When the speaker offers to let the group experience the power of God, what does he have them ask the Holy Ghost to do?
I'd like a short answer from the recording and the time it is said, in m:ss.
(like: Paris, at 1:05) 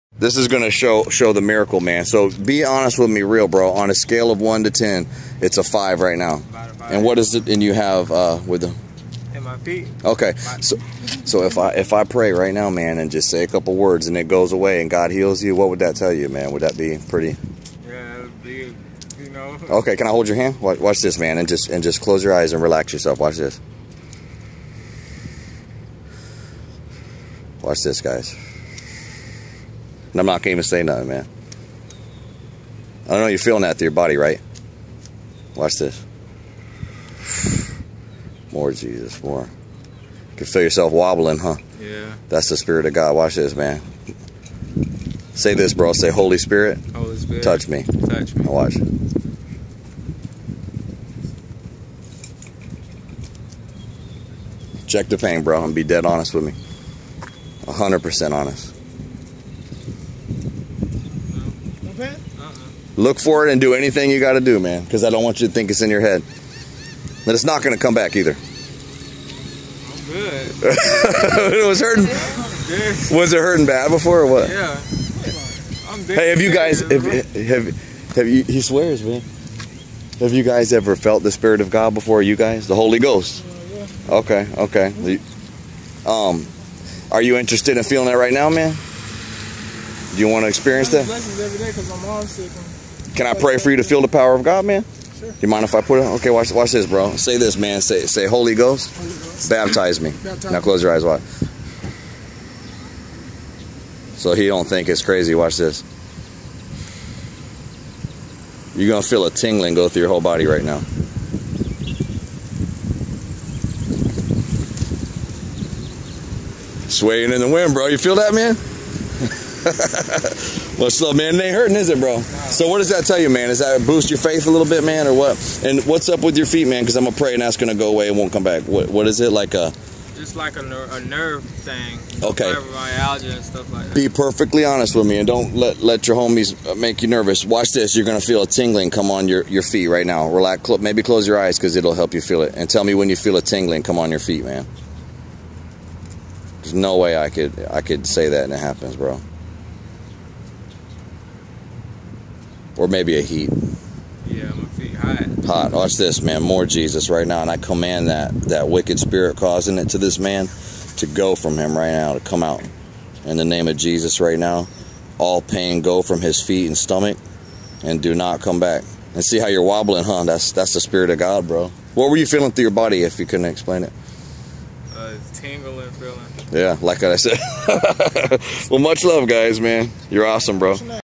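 Baptize me, at 1:39.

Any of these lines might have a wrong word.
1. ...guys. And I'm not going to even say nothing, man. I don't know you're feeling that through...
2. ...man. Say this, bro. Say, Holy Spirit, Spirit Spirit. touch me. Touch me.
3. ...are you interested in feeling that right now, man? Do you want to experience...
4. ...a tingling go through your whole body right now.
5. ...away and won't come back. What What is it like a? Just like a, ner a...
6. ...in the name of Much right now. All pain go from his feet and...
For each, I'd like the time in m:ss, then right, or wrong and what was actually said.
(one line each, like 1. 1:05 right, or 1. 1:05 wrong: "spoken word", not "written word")
1. 0:28 right
2. 0:43 wrong: "Holy", not "Spirit"
3. 1:27 right
4. 1:49 right
5. 2:07 right
6. 2:43 wrong: "Jesus", not "Much".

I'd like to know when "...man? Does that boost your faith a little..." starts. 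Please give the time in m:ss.
2:03.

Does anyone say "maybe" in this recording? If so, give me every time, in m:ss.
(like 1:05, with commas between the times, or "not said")
2:20, 2:32.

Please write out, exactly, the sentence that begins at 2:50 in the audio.
That's that's the spirit of God, bro.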